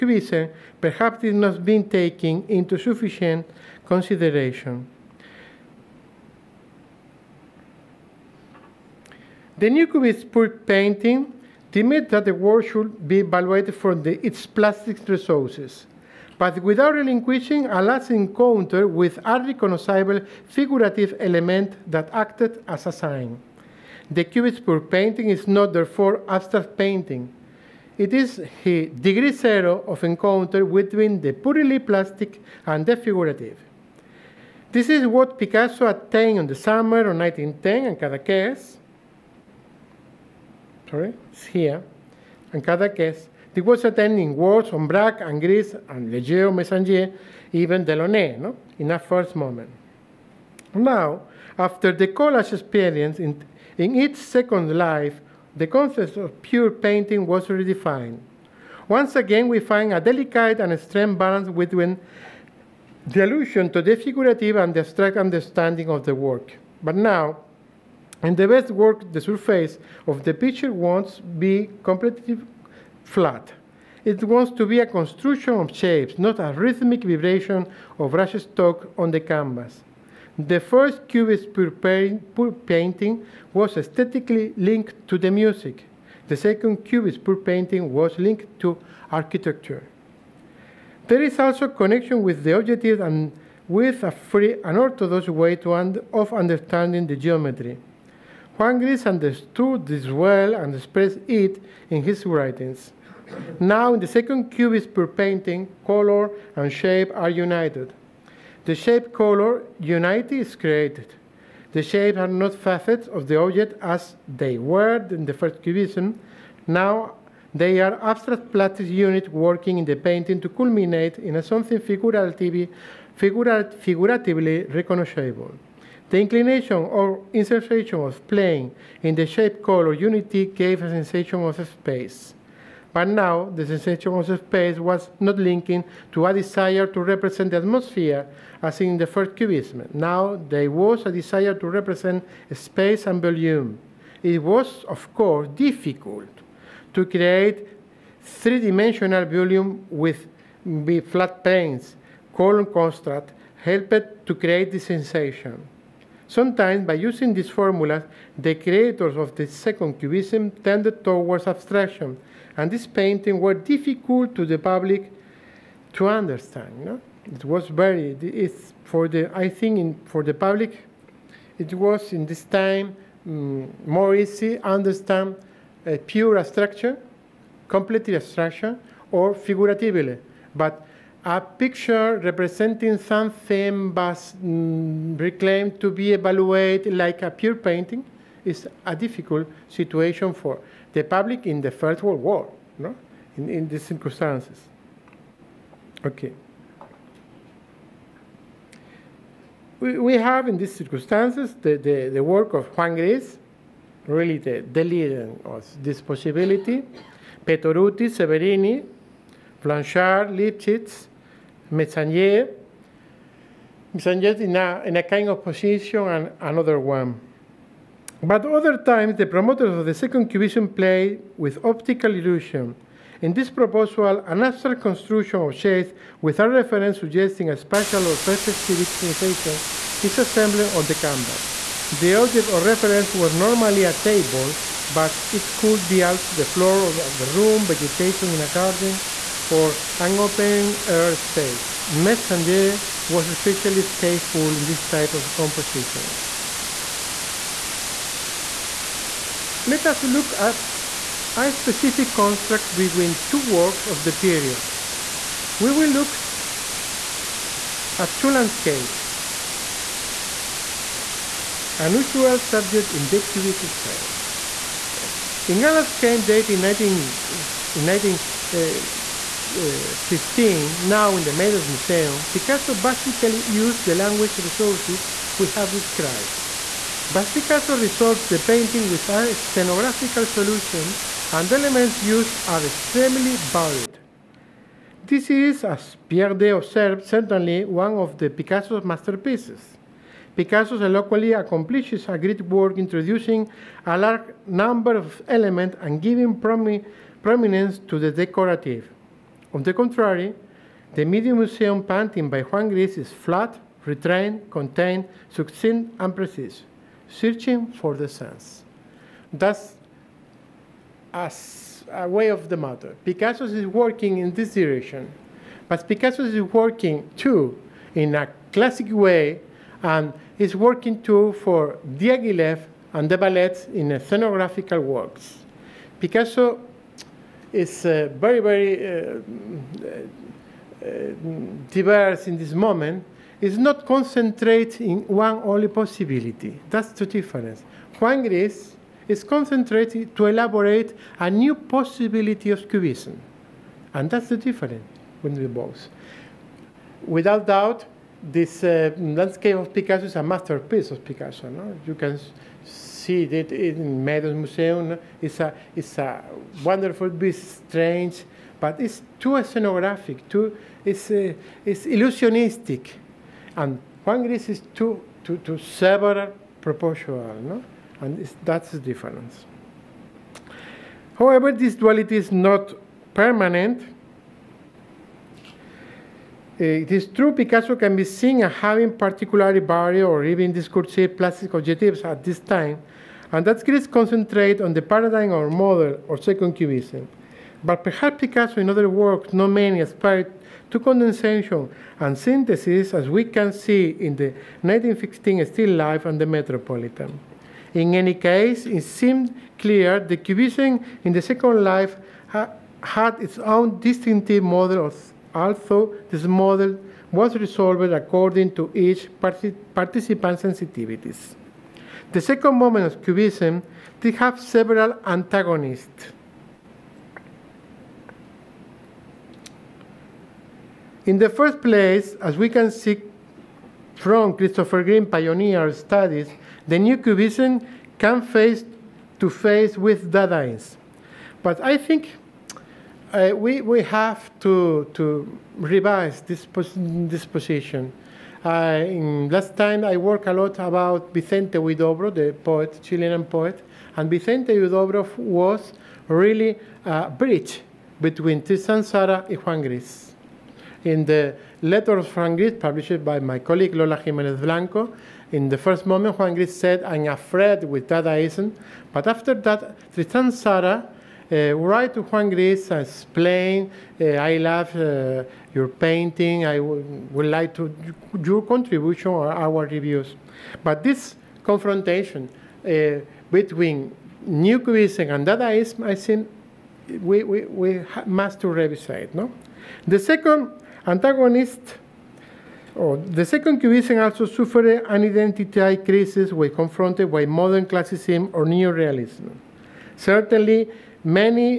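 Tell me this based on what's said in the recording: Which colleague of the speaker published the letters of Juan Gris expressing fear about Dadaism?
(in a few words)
Lola Jimenez Blanco.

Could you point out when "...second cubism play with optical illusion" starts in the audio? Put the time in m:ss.
3:39.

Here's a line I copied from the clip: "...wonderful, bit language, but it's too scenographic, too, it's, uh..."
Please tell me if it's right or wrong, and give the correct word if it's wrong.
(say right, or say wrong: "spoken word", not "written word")
wrong: "strange", not "language".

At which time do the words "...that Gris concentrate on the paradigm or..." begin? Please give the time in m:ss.
6:23.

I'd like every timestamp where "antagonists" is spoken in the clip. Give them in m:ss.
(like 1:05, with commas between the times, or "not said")
6:55, 8:00.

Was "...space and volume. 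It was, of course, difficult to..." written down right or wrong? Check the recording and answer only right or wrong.
right.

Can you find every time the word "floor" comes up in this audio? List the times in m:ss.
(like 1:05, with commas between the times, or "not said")
3:56.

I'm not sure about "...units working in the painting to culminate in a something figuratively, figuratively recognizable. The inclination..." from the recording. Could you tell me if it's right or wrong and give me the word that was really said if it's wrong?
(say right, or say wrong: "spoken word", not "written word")
right.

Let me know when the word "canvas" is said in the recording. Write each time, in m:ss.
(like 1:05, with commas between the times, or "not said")
1:19, 3:50.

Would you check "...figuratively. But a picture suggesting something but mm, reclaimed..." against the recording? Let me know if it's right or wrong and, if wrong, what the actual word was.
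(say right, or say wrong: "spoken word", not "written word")
wrong: "representing", not "suggesting".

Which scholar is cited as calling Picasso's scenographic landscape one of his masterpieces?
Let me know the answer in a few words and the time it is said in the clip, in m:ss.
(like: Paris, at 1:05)
Pierre Daix, at 4:46.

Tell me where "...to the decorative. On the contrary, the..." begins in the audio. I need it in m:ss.
4:57.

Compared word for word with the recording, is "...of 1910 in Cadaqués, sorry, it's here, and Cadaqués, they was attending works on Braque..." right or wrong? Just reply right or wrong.
right.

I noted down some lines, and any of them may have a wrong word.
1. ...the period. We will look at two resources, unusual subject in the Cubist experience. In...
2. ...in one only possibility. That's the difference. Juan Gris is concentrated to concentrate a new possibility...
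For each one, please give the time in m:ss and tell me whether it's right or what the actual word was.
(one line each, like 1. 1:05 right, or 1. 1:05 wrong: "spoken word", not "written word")
1. 4:14 wrong: "landscapes", not "resources"
2. 5:34 wrong: "elaborate", not "concentrate".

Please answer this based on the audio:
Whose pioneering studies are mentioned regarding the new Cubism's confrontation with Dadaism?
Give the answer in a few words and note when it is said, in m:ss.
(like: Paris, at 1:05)
Christopher Green, at 7:04.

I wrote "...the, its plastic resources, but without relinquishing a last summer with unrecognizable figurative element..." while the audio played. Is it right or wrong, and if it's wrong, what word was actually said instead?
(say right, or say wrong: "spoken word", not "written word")
wrong: "encounter", not "summer".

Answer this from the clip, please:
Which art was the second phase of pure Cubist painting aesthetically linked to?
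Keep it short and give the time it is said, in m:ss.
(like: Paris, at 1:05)
Architecture, at 1:29.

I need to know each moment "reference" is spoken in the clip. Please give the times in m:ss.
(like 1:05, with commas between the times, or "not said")
3:46, 3:52.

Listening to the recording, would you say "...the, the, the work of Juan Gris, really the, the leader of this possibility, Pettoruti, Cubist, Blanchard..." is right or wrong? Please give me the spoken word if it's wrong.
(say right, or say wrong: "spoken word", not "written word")
wrong: "Severini", not "Cubist".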